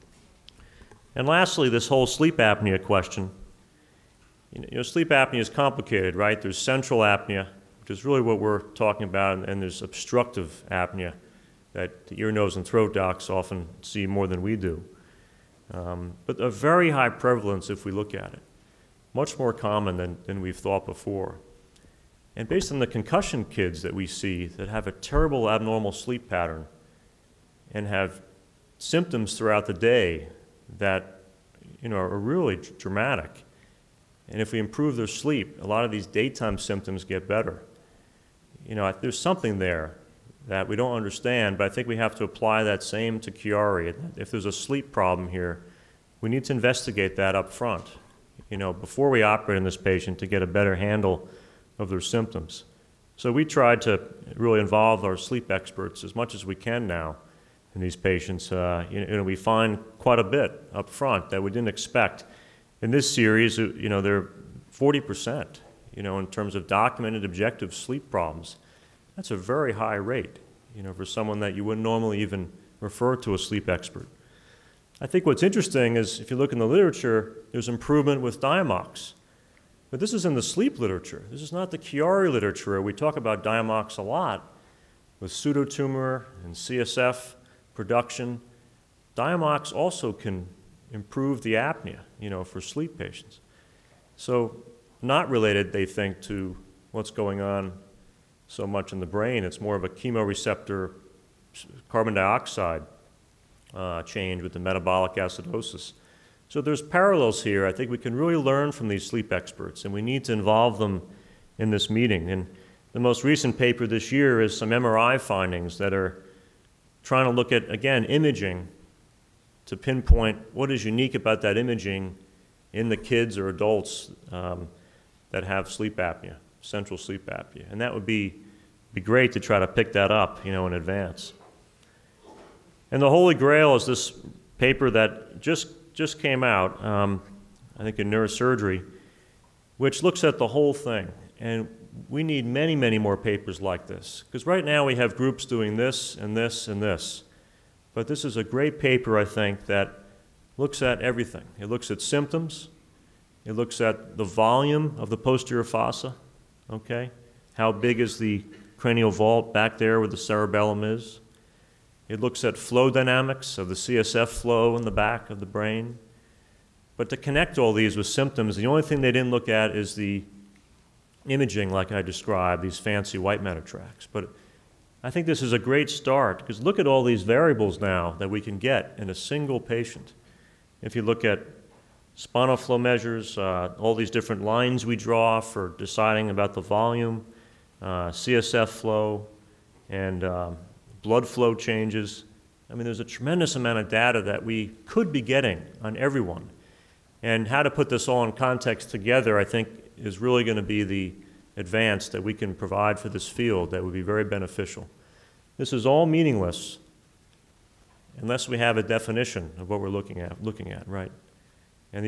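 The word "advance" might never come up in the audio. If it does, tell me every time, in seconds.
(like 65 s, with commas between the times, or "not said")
130 s, 201 s.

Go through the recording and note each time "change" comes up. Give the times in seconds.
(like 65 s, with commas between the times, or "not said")
104 s, 191 s.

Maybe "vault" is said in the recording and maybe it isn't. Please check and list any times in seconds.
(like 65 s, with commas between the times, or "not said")
159 s.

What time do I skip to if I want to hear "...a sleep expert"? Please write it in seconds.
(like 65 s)
73 s.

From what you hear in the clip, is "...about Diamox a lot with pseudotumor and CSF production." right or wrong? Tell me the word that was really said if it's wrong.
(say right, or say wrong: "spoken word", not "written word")
right.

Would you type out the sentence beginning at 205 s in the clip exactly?
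This is all meaningless unless we have a definition of what we're looking at, looking at, right?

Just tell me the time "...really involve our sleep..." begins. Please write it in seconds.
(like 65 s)
54 s.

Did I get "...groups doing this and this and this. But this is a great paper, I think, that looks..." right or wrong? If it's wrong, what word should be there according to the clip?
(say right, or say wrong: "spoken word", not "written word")
right.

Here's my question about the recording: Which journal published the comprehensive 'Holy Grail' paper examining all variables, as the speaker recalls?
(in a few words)
Neurosurgery.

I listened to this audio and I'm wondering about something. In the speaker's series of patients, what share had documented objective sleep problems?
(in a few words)
40%.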